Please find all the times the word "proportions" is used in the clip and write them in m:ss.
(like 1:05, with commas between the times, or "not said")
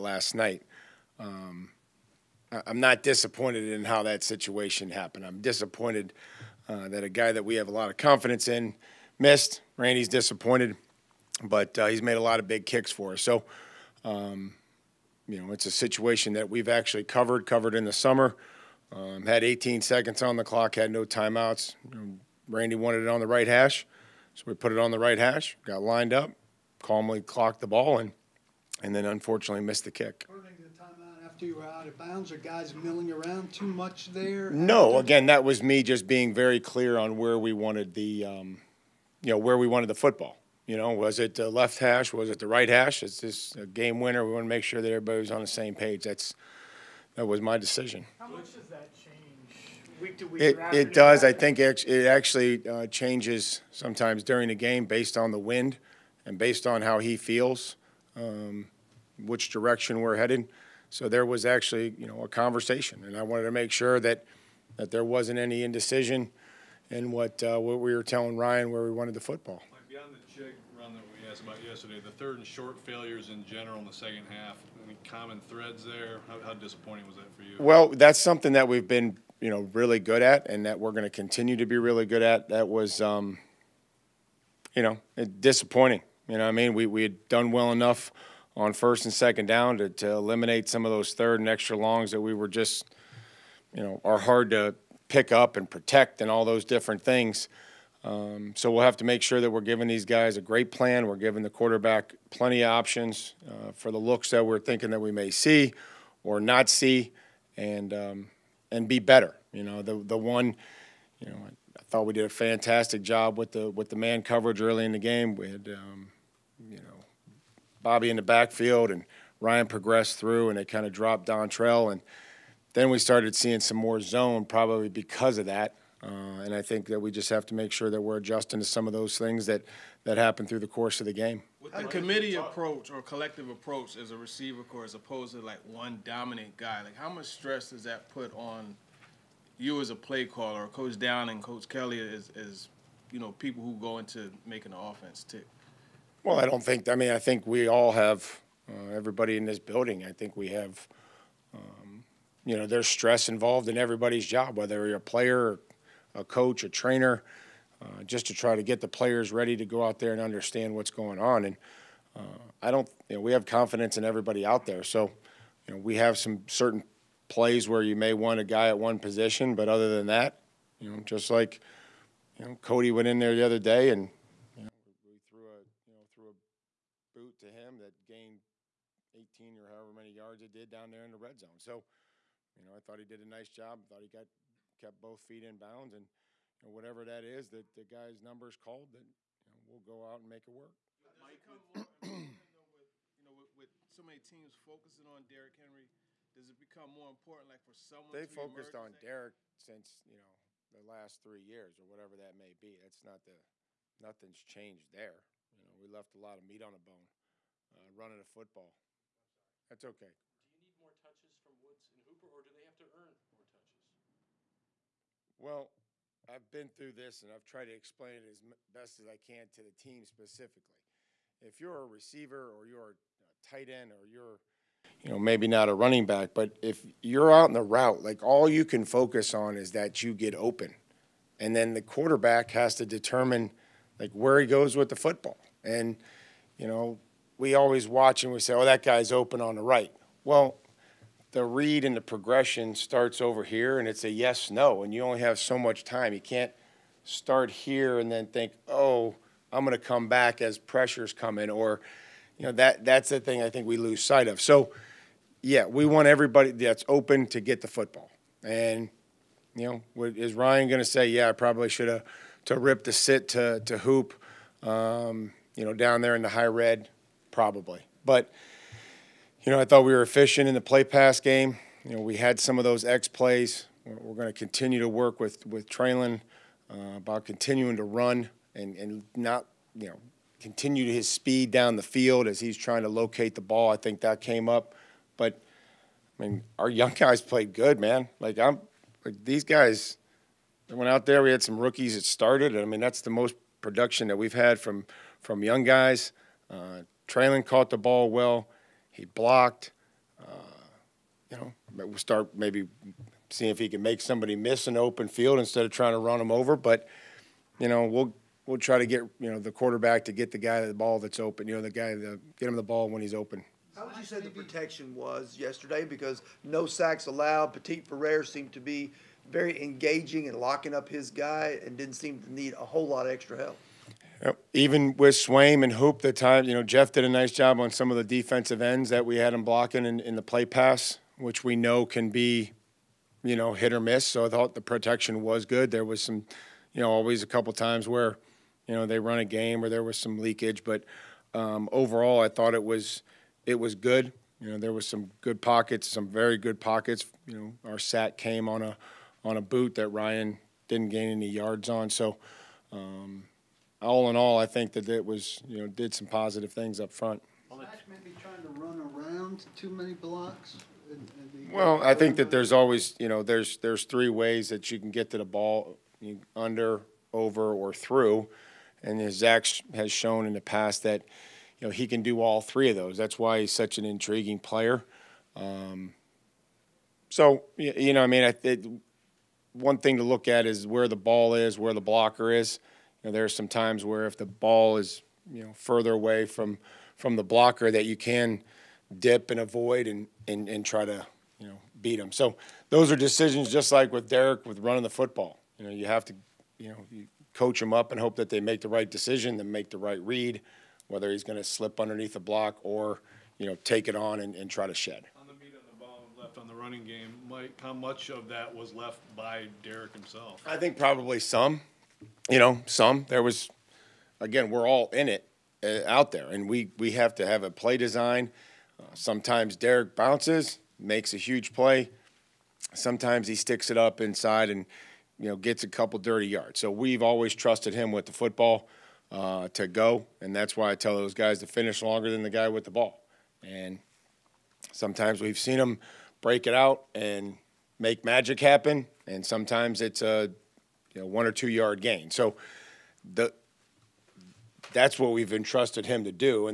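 not said.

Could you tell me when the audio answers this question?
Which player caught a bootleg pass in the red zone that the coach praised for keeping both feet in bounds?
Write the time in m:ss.
2:52.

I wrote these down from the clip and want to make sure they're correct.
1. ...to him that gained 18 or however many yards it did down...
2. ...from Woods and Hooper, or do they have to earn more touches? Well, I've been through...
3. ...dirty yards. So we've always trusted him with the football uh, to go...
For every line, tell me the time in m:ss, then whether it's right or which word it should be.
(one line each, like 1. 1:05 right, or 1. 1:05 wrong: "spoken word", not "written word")
1. 2:57 right
2. 3:31 right
3. 7:05 right.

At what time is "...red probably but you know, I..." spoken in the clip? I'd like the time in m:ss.
4:26.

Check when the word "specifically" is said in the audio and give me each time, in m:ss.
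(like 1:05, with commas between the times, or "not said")
3:40.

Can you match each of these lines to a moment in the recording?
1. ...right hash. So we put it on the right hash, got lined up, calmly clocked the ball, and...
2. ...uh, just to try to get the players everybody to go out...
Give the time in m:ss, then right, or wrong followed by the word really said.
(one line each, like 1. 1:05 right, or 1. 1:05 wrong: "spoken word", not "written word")
1. 0:23 right
2. 2:37 wrong: "ready", not "everybody".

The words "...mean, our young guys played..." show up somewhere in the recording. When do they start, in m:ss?
4:46.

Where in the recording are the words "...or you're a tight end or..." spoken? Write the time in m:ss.
3:42.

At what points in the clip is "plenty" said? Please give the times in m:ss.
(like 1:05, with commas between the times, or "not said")
1:42.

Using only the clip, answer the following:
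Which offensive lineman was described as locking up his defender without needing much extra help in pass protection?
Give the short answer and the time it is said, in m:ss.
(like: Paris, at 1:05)
Petit-Frere, at 5:17.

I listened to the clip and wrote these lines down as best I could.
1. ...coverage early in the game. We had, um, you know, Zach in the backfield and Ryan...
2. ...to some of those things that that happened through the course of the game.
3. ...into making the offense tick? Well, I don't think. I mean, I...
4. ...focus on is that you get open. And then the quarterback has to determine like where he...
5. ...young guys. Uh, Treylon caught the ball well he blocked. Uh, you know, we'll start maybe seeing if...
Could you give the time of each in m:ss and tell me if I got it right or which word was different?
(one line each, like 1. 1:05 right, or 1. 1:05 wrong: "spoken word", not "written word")
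1. 1:54 wrong: "Bobby", not "Zach"
2. 2:08 right
3. 2:23 right
4. 3:48 right
5. 4:55 right.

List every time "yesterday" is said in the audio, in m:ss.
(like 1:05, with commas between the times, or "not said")
1:11, 5:15.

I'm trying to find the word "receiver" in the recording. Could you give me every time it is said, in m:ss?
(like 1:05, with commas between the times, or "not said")
2:14, 3:41.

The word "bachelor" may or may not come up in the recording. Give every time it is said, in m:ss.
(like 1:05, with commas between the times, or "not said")
not said.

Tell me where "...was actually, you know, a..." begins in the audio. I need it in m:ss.
1:01.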